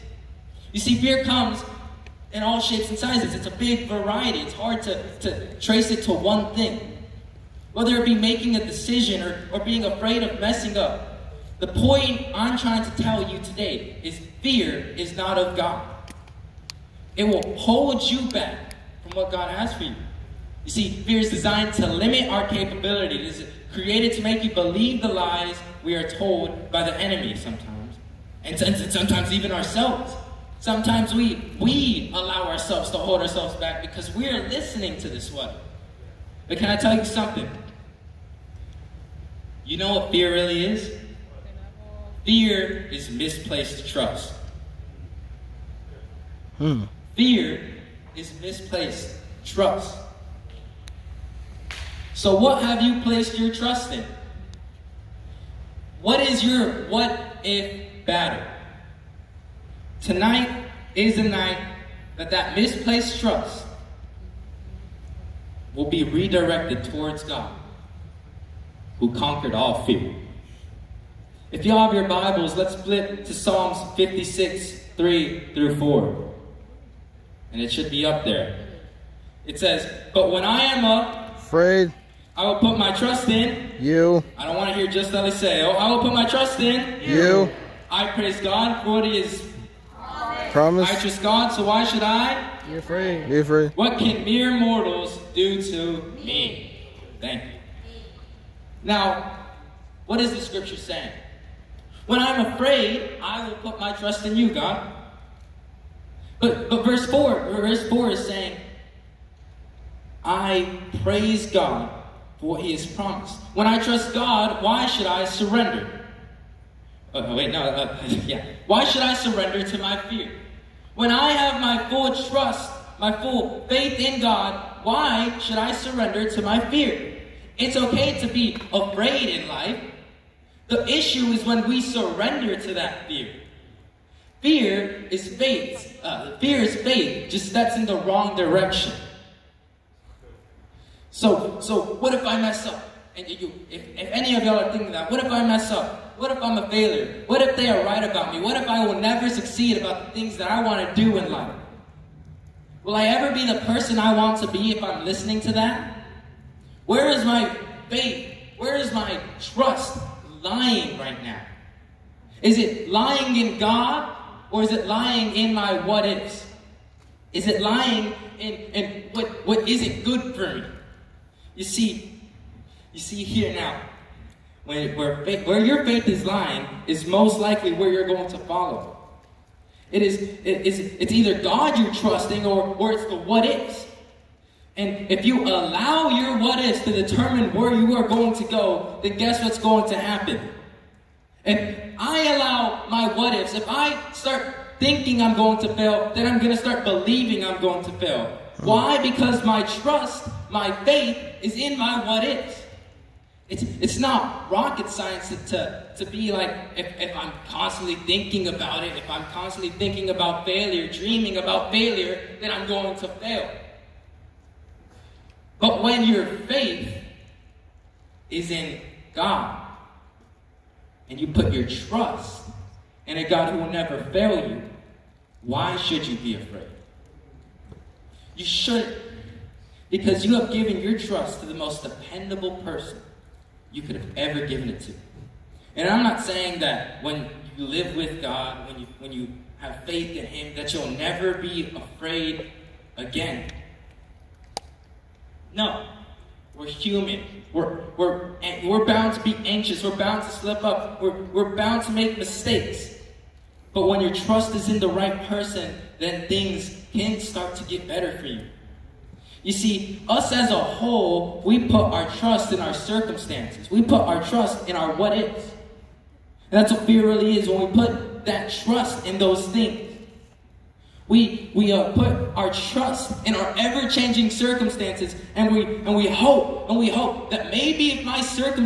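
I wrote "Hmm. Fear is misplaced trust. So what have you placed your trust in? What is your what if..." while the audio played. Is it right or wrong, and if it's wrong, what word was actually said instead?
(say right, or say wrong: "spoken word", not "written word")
right.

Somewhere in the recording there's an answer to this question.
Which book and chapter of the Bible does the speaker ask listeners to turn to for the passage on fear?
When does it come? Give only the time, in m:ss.
1:13.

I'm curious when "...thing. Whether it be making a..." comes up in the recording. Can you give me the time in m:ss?
0:06.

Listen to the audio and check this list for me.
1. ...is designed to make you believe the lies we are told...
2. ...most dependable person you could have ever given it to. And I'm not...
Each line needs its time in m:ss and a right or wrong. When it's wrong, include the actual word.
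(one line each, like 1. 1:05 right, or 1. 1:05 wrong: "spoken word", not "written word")
1. 0:23 wrong: "created", not "designed"
2. 3:51 right.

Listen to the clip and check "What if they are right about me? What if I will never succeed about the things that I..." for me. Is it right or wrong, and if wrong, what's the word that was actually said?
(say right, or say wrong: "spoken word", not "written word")
right.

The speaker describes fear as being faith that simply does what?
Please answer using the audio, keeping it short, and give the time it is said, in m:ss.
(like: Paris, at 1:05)
Steps in the wrong direction, at 2:17.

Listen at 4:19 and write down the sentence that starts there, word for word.
You see, us as a whole, we put our trust in our circumstances.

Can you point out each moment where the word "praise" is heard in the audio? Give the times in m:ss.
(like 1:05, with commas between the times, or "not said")
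1:28, 1:51.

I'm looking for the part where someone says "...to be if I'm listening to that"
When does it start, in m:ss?
2:34.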